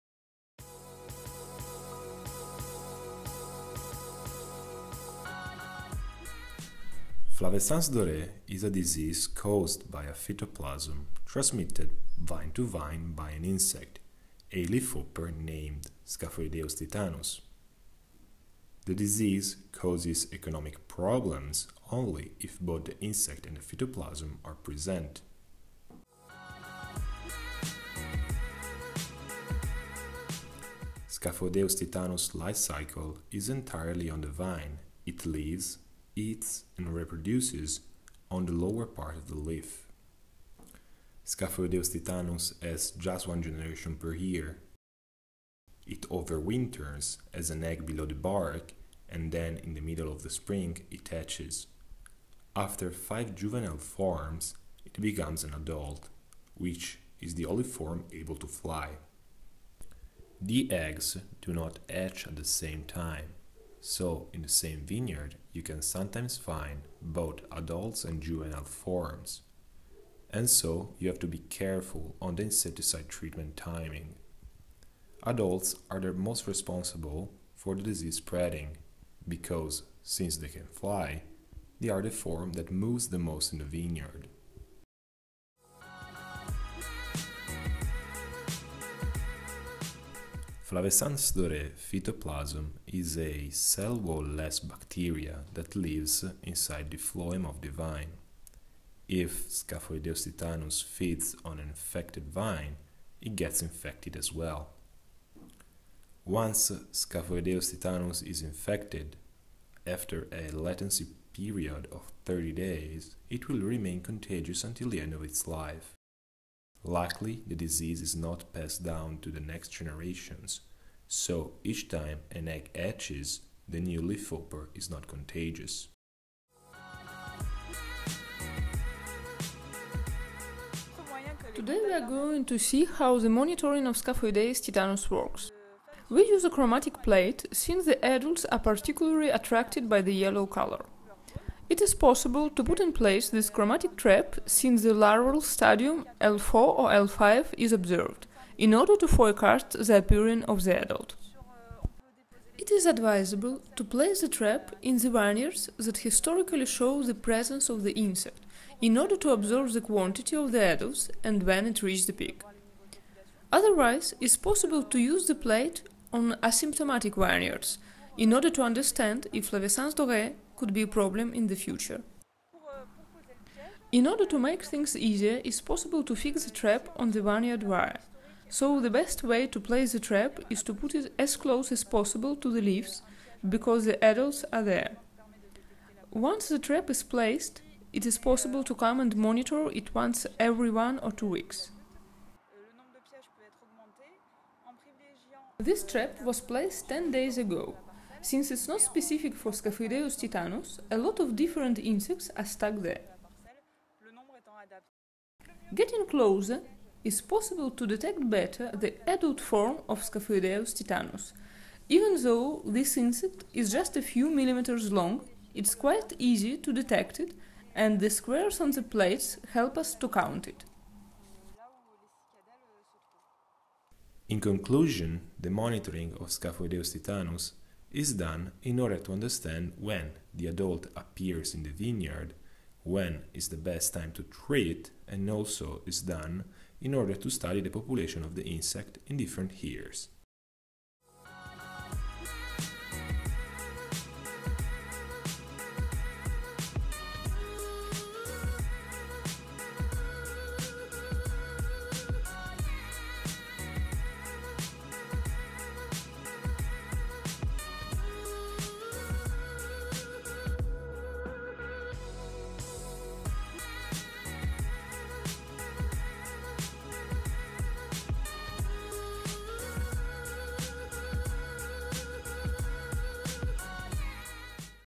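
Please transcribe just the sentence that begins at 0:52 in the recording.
After five juvenile forms, it becomes an adult, which is the only form able to fly.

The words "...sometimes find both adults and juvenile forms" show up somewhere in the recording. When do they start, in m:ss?
1:05.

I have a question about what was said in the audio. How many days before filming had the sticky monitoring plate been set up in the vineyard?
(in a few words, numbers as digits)
10 days.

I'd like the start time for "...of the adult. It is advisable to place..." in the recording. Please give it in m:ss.
2:30.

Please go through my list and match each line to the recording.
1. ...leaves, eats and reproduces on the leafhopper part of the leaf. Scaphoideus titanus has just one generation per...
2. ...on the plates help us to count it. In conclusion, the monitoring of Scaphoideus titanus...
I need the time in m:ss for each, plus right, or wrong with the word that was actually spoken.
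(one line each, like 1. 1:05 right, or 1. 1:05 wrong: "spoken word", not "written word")
1. 0:35 wrong: "lower", not "leafhopper"
2. 3:38 right.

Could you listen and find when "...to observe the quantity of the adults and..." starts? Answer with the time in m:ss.
2:39.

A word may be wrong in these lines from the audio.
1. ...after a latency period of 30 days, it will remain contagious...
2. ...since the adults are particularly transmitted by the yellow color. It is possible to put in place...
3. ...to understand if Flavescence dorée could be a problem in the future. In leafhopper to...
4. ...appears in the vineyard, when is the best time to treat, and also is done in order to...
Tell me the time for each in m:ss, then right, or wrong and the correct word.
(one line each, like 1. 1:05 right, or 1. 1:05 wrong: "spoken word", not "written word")
1. 1:49 right
2. 2:17 wrong: "attracted", not "transmitted"
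3. 2:48 wrong: "order", not "leafhopper"
4. 3:50 right.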